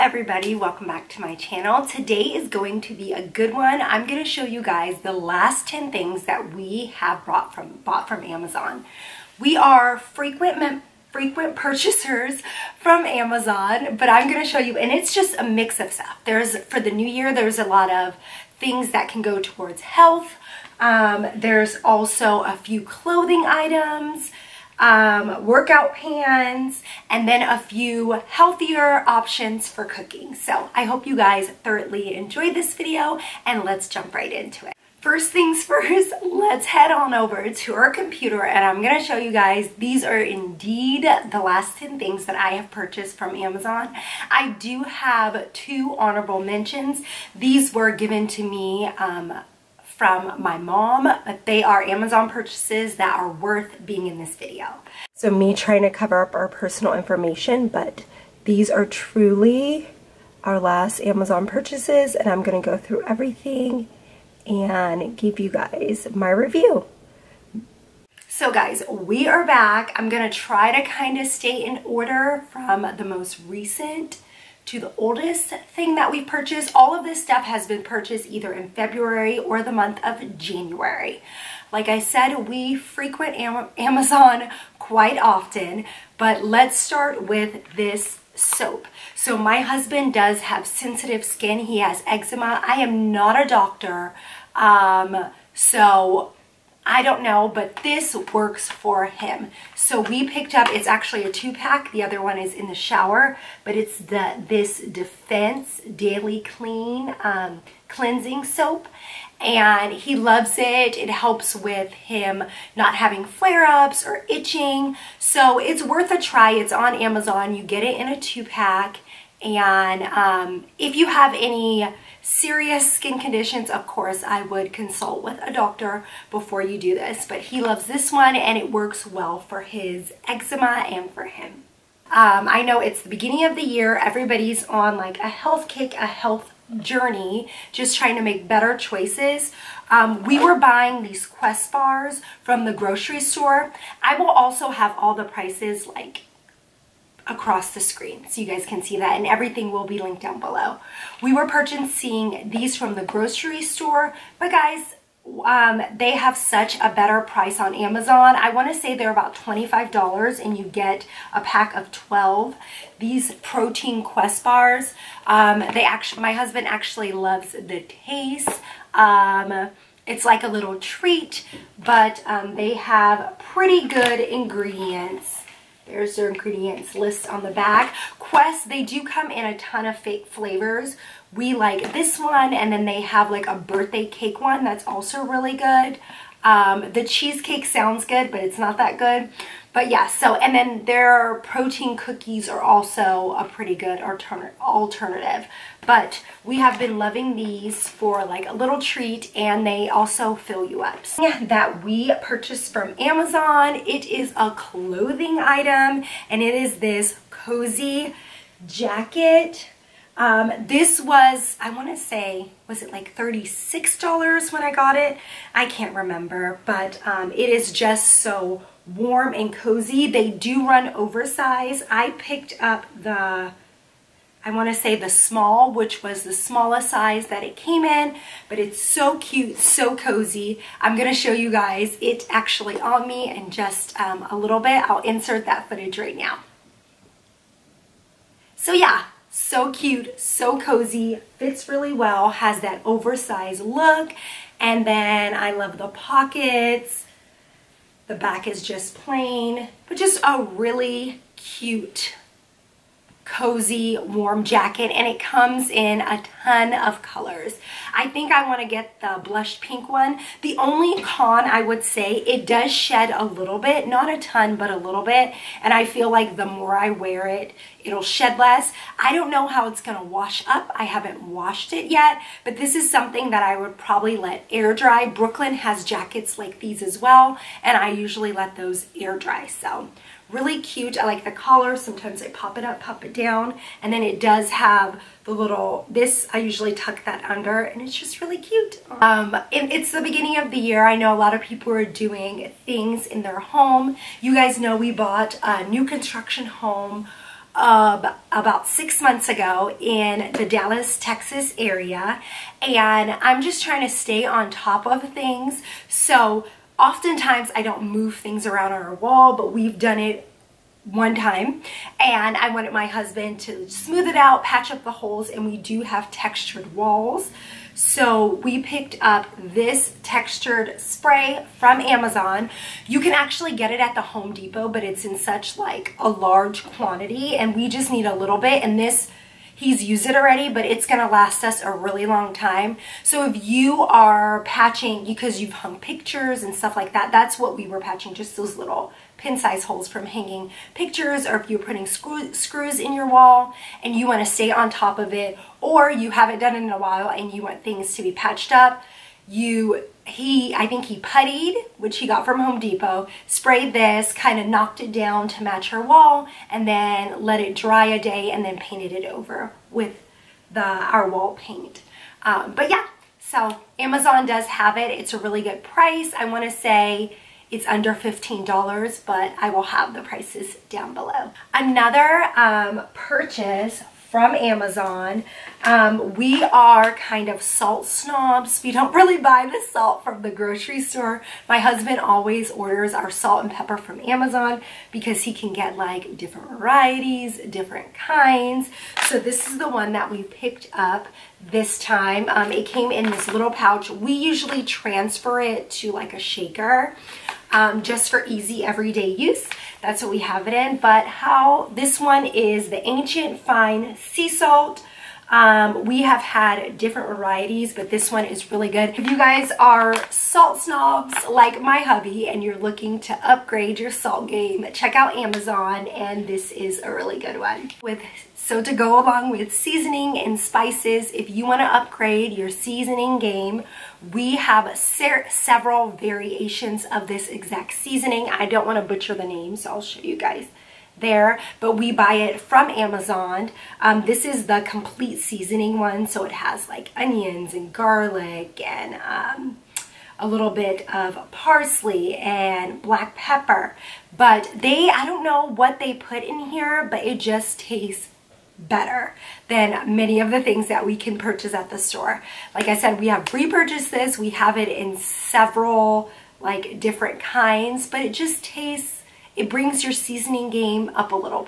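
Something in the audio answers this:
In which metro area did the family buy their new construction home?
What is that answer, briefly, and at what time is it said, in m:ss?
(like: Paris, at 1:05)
Dallas, Texas, at 5:00.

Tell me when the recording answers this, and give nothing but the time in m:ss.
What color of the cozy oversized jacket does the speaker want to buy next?
4:19.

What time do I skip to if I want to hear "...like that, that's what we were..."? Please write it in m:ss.
5:36.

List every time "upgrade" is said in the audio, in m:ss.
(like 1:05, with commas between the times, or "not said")
6:53, 7:01.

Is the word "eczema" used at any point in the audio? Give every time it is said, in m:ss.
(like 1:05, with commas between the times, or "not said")
1:32, 2:10.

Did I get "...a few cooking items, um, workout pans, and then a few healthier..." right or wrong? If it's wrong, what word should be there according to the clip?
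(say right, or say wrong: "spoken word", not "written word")
wrong: "clothing", not "cooking".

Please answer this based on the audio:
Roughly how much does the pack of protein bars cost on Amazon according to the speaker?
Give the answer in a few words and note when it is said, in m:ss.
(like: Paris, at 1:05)
$25, at 2:39.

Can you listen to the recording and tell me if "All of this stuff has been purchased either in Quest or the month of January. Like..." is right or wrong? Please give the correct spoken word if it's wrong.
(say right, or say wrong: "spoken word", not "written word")
wrong: "February", not "Quest".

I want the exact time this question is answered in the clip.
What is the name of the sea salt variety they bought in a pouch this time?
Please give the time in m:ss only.
6:42.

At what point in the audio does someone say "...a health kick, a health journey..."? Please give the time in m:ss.
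2:15.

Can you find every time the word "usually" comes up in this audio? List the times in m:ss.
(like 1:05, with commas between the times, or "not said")
4:37, 4:46, 6:34.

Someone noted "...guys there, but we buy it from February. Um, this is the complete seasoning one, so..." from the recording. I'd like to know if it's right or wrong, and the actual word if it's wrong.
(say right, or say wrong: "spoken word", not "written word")
wrong: "Amazon", not "February".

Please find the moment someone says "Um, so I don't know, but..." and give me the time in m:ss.
1:34.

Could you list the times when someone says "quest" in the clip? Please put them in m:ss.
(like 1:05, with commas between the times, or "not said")
2:21, 2:44, 2:58.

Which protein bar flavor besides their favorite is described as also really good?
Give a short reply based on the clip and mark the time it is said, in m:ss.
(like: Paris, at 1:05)
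birthday cake, at 3:03.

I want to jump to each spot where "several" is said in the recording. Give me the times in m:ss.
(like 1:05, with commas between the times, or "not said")
7:04, 7:34.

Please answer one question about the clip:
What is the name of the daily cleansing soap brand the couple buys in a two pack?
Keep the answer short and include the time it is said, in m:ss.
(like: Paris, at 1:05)
Defense, at 1:44.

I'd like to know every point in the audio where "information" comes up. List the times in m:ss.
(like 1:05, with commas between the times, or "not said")
0:56.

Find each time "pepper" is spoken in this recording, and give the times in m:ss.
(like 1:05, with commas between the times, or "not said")
6:23, 7:23.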